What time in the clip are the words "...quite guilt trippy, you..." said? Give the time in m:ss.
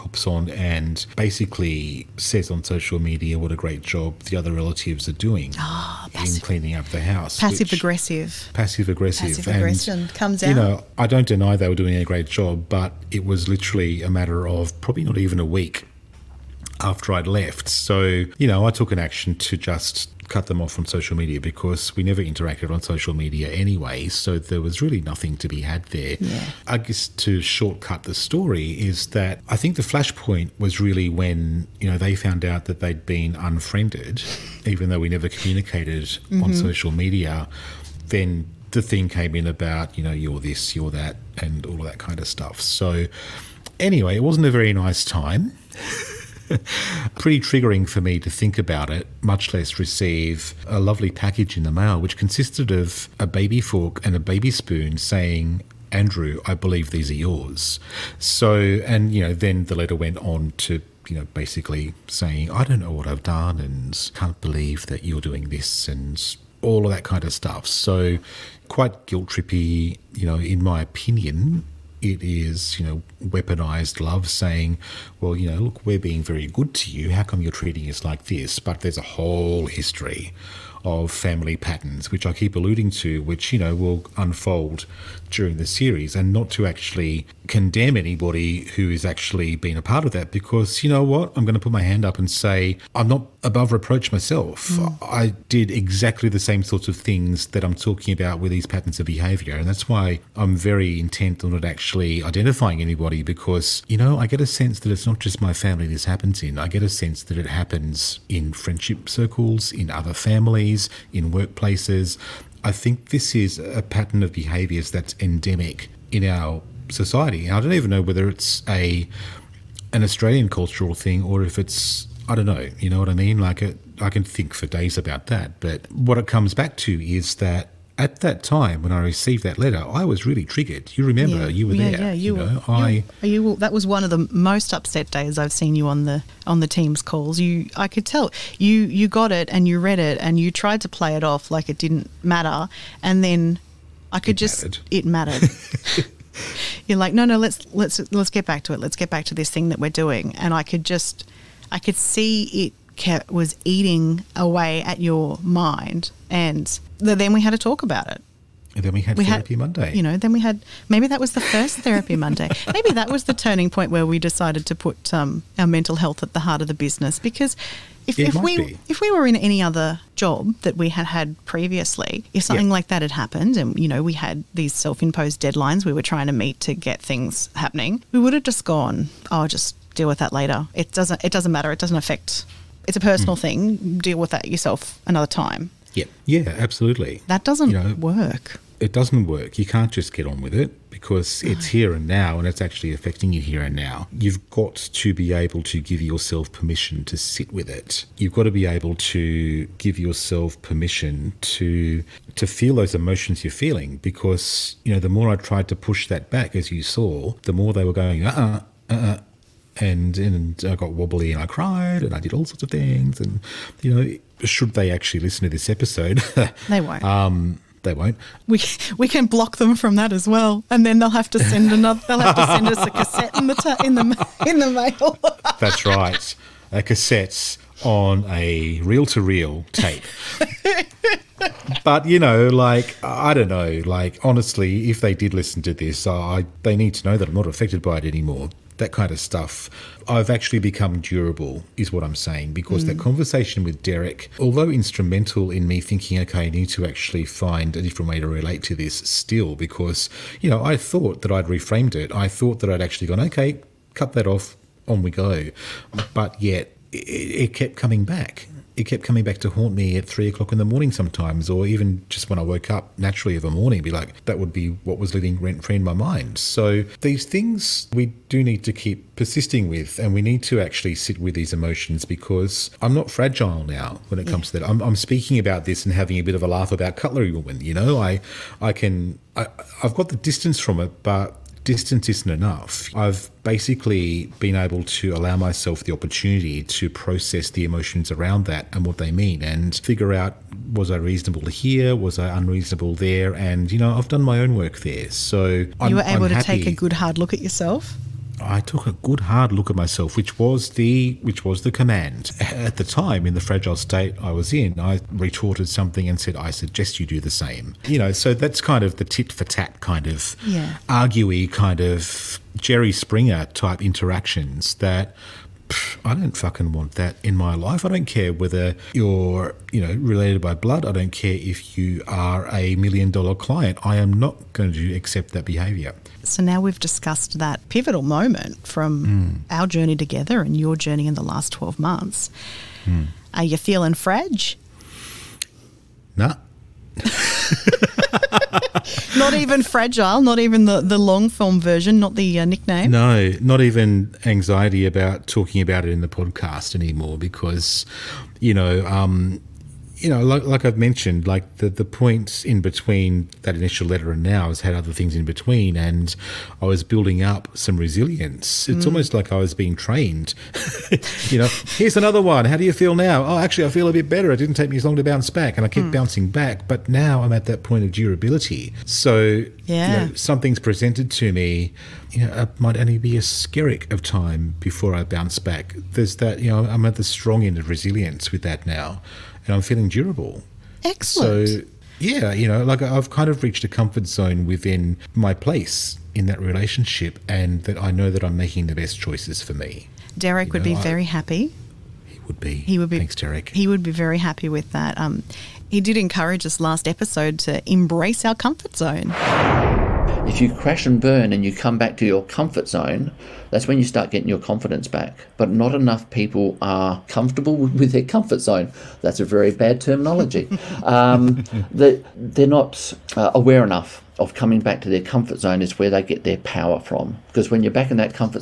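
1:08.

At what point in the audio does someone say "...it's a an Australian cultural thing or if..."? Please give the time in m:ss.
1:58.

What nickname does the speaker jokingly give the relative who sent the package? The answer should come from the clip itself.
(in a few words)
Cutlery Woman.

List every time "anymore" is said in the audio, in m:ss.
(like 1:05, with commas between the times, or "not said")
3:58, 5:46.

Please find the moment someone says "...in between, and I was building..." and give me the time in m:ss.
5:55.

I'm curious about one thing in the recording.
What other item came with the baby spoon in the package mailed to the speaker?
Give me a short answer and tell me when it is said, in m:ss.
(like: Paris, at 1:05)
baby fork, at 0:53.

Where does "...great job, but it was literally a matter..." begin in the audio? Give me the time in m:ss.
0:12.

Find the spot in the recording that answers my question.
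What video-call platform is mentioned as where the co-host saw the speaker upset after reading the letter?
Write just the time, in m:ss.
2:16.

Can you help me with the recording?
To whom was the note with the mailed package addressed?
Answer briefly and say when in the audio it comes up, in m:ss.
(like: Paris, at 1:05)
Andrew, at 0:55.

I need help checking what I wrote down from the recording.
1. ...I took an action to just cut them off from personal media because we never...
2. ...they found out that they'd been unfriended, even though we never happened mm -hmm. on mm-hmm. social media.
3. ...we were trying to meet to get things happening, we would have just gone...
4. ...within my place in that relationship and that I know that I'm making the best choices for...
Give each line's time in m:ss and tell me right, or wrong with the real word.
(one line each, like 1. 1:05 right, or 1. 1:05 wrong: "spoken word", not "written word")
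1. 0:18 wrong: "social", not "personal"
2. 0:31 wrong: "communicated", not "happened"
3. 2:55 right
4. 6:24 right.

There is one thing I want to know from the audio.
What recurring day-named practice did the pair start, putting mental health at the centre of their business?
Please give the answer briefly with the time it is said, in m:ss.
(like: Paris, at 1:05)
Therapy Monday, at 2:41.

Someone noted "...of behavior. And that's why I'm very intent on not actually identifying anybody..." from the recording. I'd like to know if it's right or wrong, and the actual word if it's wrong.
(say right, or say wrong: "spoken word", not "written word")
right.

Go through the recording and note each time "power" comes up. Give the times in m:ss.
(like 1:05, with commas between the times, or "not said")
6:56.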